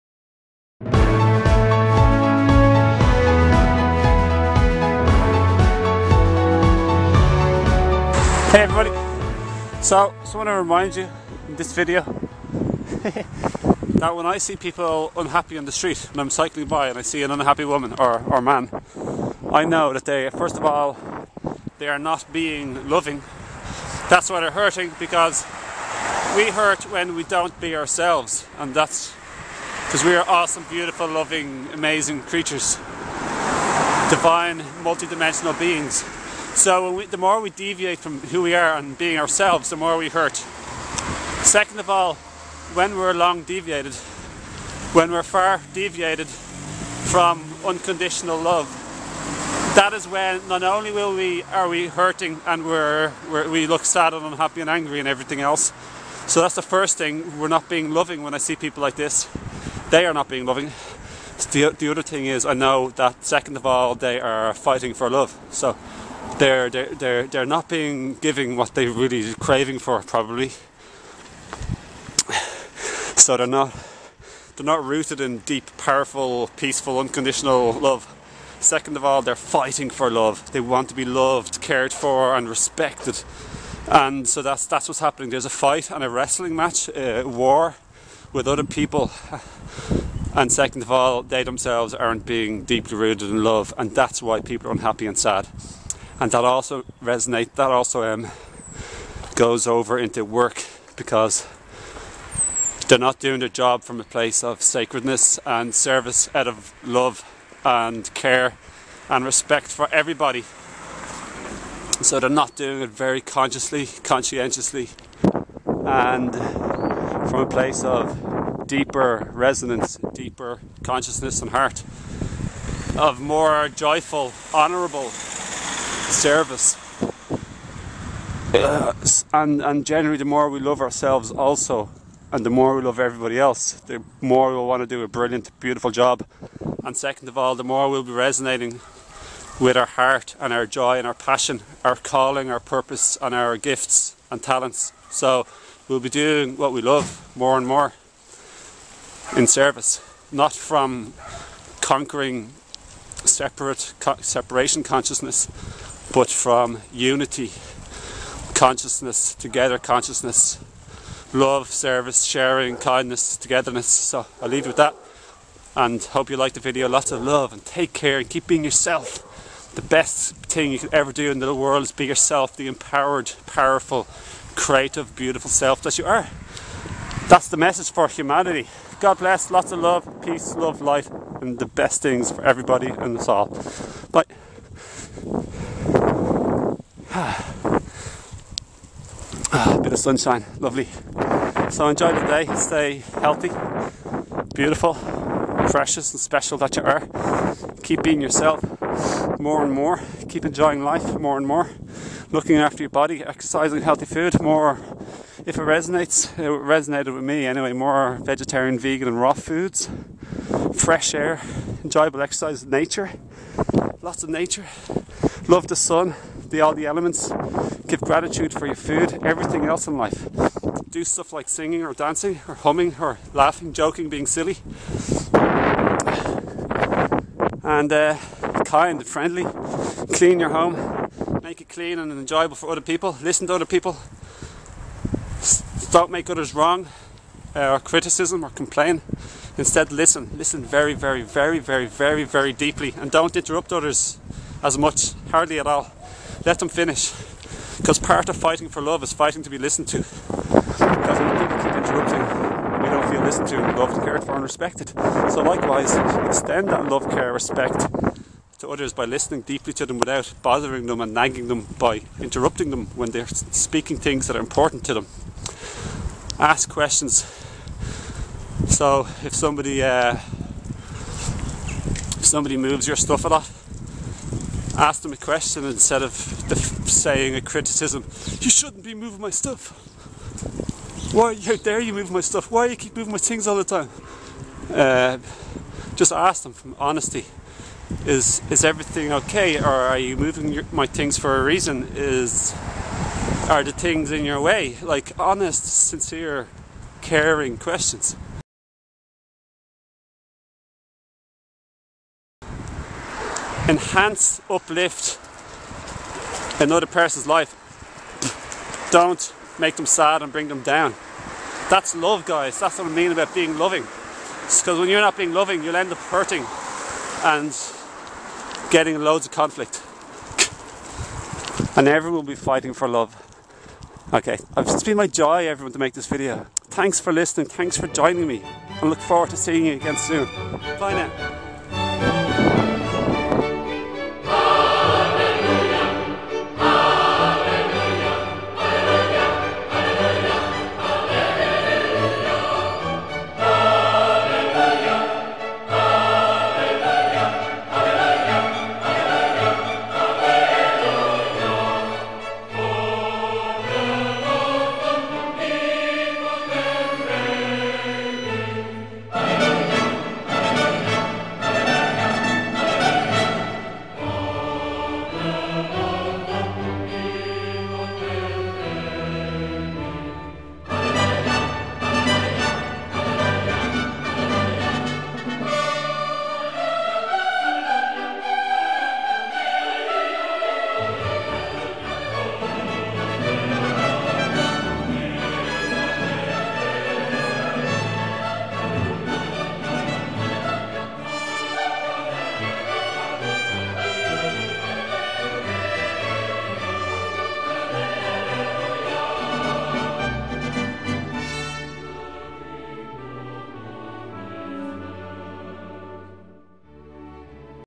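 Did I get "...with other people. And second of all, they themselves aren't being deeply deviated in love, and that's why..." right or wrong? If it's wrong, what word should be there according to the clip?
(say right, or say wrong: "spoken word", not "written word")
wrong: "rooted", not "deviated".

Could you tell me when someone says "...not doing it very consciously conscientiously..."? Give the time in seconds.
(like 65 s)
112 s.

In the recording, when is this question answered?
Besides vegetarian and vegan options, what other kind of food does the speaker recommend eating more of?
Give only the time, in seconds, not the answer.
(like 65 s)
209 s.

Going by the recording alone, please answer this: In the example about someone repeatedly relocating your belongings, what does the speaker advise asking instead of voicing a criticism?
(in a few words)
a question.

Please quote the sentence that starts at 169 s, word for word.
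The best thing you could ever do in the world is be yourself, the empowered, powerful, creative, beautiful self that you are.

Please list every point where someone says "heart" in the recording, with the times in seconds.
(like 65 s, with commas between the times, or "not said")
121 s, 139 s.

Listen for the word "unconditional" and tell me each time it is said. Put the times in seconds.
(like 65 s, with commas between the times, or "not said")
47 s, 76 s.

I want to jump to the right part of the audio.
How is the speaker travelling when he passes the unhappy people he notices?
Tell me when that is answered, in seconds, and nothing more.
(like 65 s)
16 s.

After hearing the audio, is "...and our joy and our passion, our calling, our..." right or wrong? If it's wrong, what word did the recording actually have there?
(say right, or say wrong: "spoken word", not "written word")
right.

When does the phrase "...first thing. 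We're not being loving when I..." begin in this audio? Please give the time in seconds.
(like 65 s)
56 s.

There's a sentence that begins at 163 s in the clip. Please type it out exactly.
So I'll leave you with that and hope you liked the video.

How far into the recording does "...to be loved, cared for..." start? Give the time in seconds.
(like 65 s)
80 s.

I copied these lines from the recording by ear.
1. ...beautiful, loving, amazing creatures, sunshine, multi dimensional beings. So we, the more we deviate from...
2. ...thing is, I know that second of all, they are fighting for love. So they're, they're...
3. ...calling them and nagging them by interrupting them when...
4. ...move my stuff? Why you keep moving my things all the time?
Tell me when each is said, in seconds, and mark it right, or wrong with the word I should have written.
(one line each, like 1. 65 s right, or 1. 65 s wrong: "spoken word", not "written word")
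1. 30 s wrong: "divine", not "sunshine"
2. 62 s right
3. 260 s wrong: "bothering", not "calling"
4. 281 s right.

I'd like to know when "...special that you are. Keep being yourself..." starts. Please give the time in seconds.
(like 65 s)
196 s.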